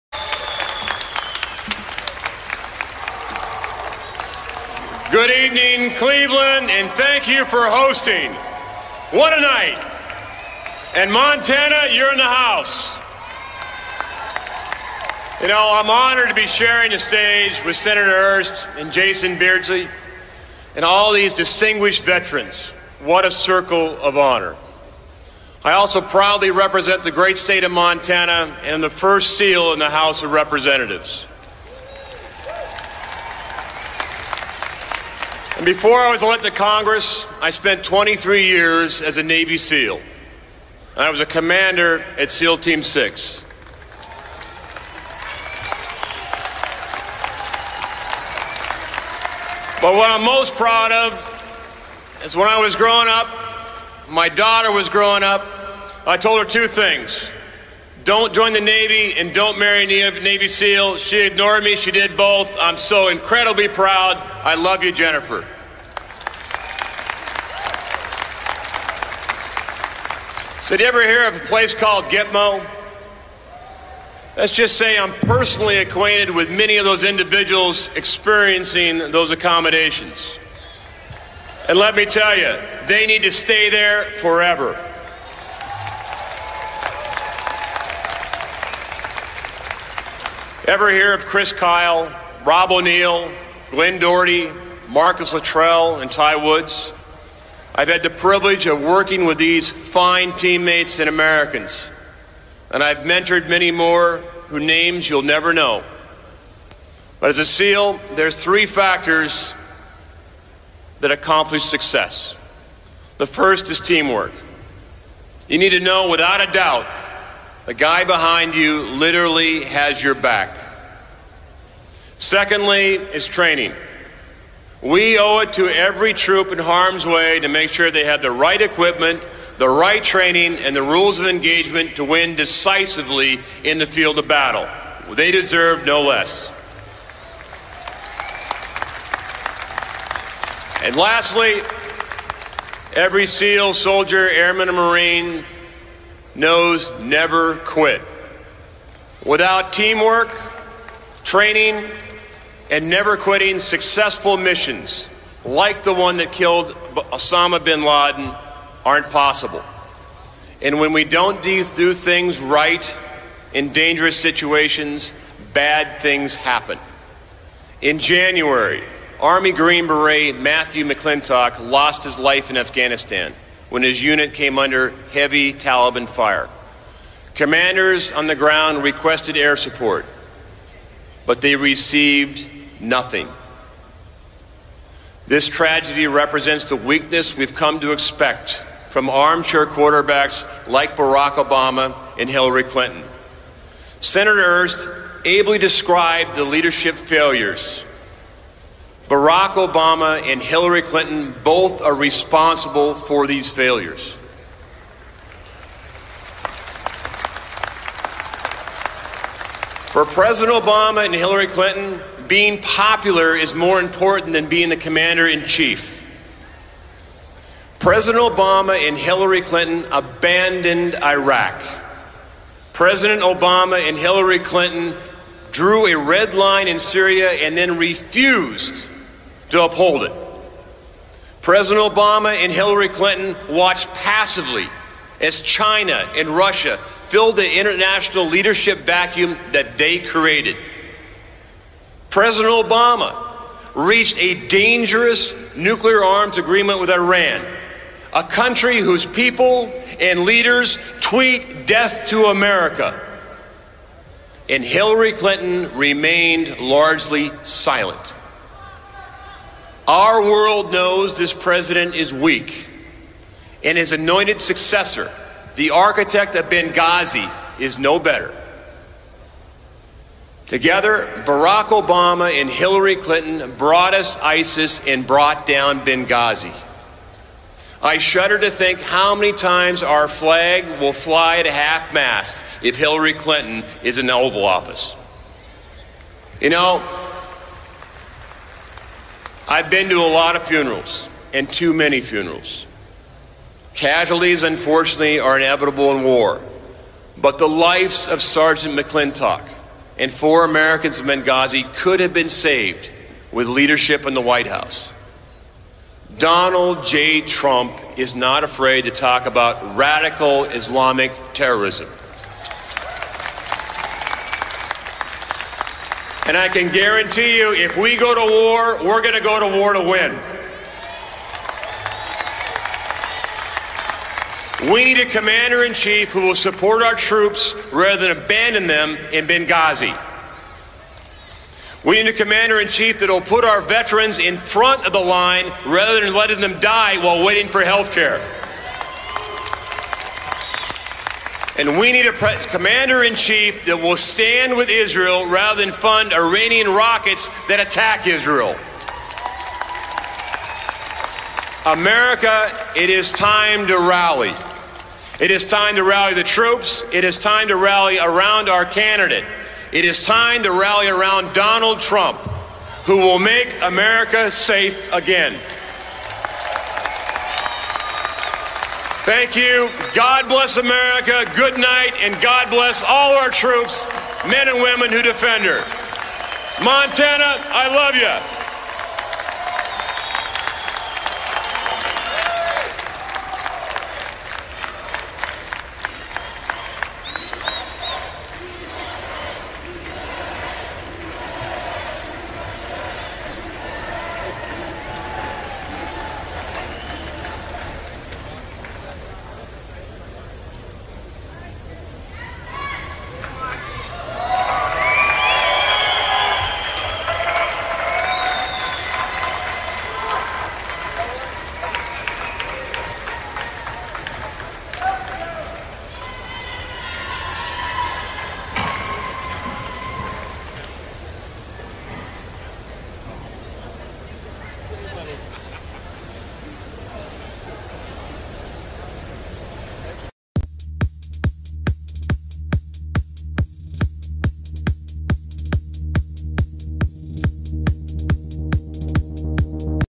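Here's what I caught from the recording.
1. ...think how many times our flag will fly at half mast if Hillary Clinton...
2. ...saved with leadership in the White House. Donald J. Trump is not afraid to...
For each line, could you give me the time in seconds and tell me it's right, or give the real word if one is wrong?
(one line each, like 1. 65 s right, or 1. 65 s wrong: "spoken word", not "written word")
1. 278 s right
2. 302 s right.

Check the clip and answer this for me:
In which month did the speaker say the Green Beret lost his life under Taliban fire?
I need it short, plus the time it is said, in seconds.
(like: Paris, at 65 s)
January, at 167 s.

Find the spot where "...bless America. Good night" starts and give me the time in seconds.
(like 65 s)
370 s.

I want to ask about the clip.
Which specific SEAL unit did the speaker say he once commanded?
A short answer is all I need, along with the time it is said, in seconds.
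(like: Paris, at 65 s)
SEAL Team 6, at 42 s.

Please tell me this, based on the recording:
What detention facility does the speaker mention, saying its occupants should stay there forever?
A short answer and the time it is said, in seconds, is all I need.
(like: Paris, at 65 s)
Gitmo, at 72 s.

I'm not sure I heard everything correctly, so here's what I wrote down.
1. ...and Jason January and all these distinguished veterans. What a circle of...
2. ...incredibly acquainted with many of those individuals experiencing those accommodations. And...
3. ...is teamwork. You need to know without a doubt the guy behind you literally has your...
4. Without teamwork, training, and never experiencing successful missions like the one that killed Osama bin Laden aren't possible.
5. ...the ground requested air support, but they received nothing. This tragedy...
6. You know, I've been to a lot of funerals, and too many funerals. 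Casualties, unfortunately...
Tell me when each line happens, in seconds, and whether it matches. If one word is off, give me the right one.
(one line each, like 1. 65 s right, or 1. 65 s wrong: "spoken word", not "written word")
1. 18 s wrong: "Beardsley", not "January"
2. 75 s wrong: "personally", not "incredibly"
3. 113 s right
4. 149 s wrong: "quitting", not "experiencing"
5. 178 s right
6. 286 s right.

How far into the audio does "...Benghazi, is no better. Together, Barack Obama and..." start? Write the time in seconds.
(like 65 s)
266 s.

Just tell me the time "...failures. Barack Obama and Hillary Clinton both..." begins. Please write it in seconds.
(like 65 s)
196 s.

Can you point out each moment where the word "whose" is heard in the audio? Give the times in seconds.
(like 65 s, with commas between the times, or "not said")
104 s, 248 s.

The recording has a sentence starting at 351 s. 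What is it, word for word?
America, it is time to rally.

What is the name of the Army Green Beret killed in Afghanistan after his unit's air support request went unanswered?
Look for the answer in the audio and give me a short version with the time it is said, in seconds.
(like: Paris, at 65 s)
Matthew McClintock, at 170 s.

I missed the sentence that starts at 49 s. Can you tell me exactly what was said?
But what I'm most proud of is when I was growing up, my daughter was growing up, I told her two things.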